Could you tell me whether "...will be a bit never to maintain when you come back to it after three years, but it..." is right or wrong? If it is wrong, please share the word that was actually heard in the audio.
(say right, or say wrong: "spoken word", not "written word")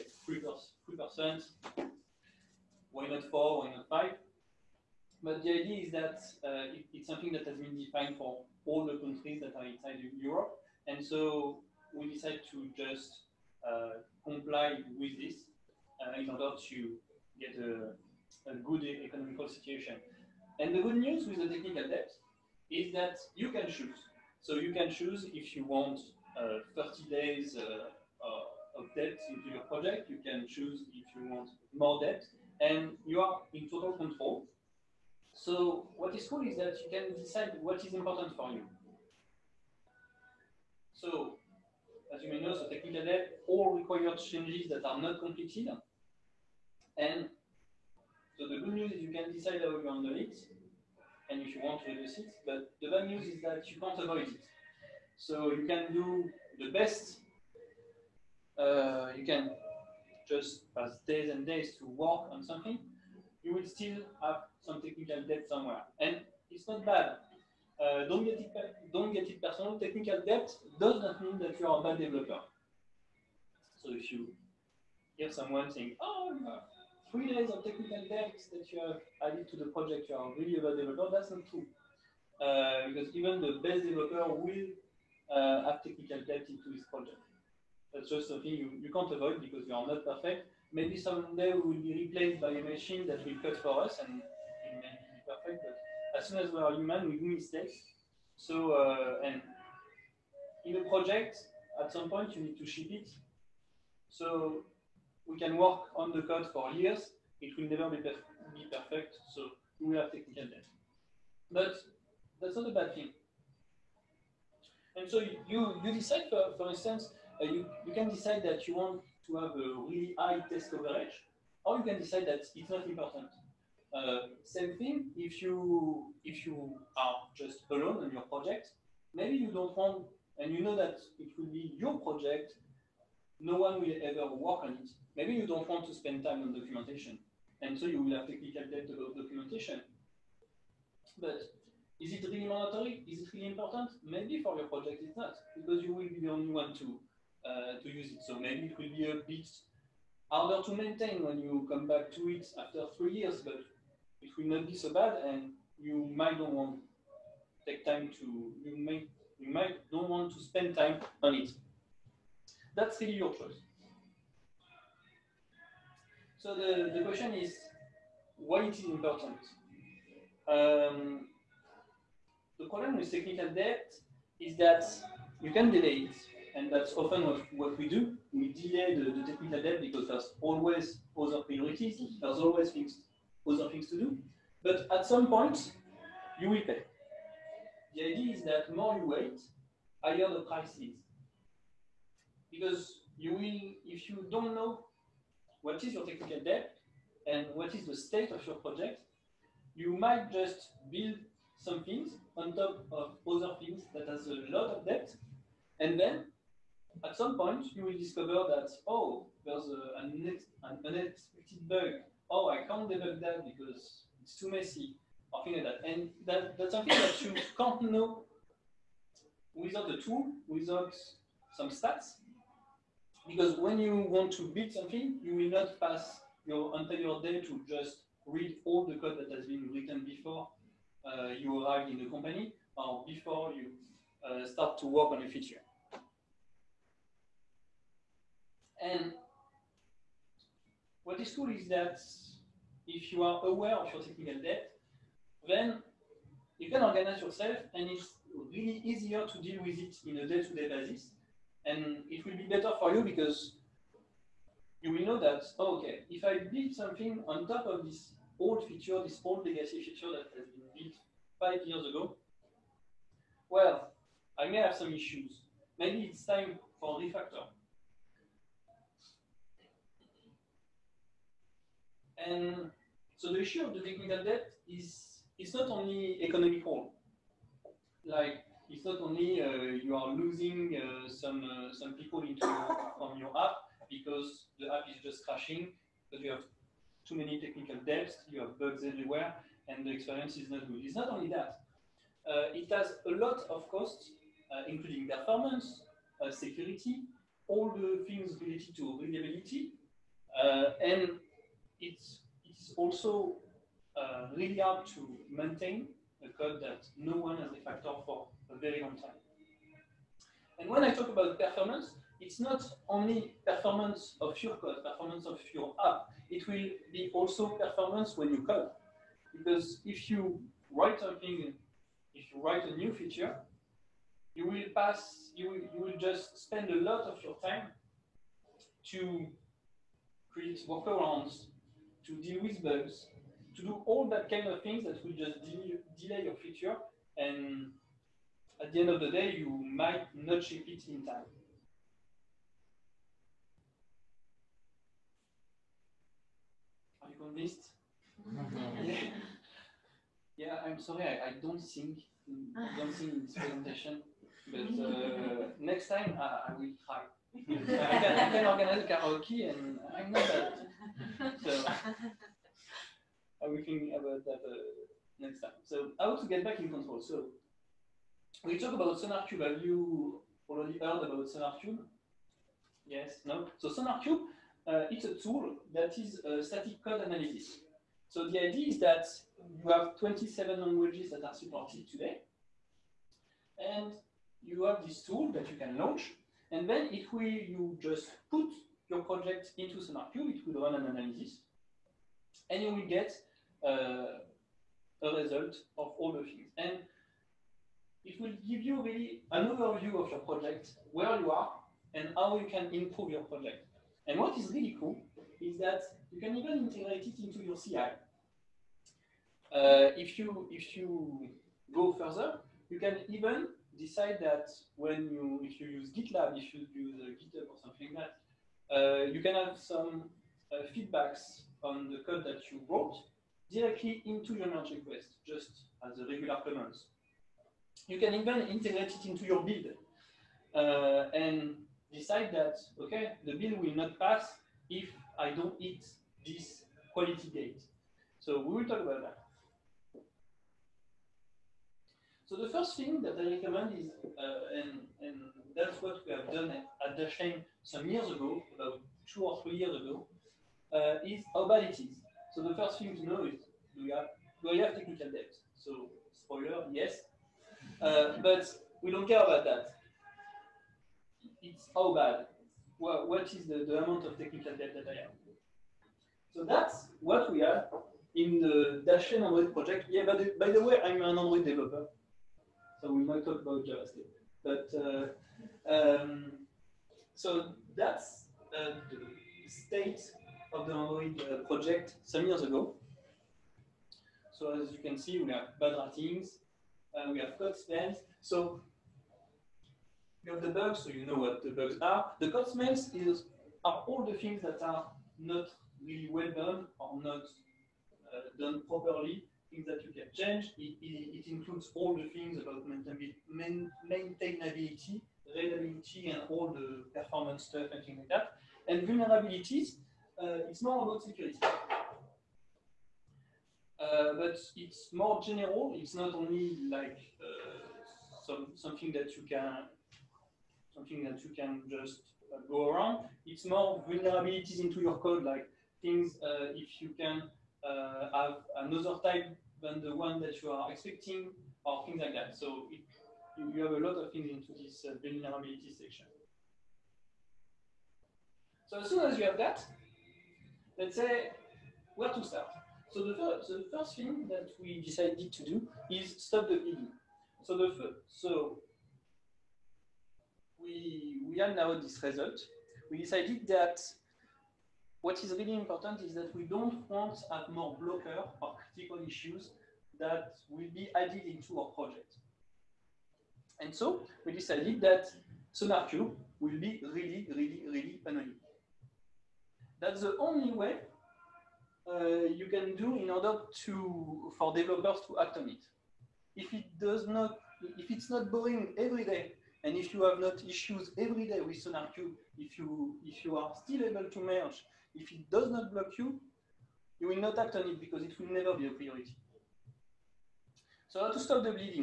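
wrong: "harder", not "never".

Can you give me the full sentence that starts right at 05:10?
And when I talk about performance, it's not only performance of your code, performance of your app.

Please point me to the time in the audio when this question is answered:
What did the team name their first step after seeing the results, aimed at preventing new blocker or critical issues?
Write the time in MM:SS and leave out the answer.
09:06.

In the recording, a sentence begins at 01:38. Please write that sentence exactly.
So, uh, and in a project, at some point, you need to ship it.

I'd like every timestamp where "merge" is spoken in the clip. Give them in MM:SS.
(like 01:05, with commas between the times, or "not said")
07:04, 09:44.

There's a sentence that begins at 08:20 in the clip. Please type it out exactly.
It, it, it includes all the things about maintainability, reliability, and all the performance stuff and things like that.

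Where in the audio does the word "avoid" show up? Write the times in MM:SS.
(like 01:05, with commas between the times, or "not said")
00:53, 01:29.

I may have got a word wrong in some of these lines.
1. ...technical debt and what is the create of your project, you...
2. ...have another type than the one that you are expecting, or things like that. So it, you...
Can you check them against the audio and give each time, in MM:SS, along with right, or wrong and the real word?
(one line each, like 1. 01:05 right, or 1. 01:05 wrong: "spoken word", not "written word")
1. 03:16 wrong: "state", not "create"
2. 08:47 right.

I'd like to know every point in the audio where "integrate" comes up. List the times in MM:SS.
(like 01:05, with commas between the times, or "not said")
06:46, 07:08.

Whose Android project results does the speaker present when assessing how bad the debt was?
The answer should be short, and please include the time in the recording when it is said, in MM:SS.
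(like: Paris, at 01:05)
Dashlane, at 07:48.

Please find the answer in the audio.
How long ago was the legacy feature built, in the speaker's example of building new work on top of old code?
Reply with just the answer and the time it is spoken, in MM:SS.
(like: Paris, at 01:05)
5 years, at 04:21.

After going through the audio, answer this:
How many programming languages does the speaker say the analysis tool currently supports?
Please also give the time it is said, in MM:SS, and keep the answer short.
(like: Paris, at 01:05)
27, at 06:19.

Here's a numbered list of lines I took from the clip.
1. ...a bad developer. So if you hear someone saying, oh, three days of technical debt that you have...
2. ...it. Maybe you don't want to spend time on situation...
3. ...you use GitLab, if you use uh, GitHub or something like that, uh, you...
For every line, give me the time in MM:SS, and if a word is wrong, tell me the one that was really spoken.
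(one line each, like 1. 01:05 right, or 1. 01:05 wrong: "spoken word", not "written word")
1. 01:11 right
2. 02:14 wrong: "documentation", not "situation"
3. 06:55 right.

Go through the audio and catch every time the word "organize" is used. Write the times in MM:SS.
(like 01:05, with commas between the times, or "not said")
04:06, 05:58.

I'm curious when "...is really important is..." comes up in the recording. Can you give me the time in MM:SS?
09:15.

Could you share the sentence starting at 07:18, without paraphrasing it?
So we will talk about that.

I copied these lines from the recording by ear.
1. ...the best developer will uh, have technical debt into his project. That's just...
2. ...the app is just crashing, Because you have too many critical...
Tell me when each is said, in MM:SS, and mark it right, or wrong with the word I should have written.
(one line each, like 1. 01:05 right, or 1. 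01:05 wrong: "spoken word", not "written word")
1. 01:23 right
2. 04:44 wrong: "technical", not "critical".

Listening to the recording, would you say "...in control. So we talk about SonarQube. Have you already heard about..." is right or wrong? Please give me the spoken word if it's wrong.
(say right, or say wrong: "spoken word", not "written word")
right.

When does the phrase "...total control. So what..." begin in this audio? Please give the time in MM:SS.
00:33.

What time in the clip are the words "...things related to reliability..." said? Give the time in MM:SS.
04:58.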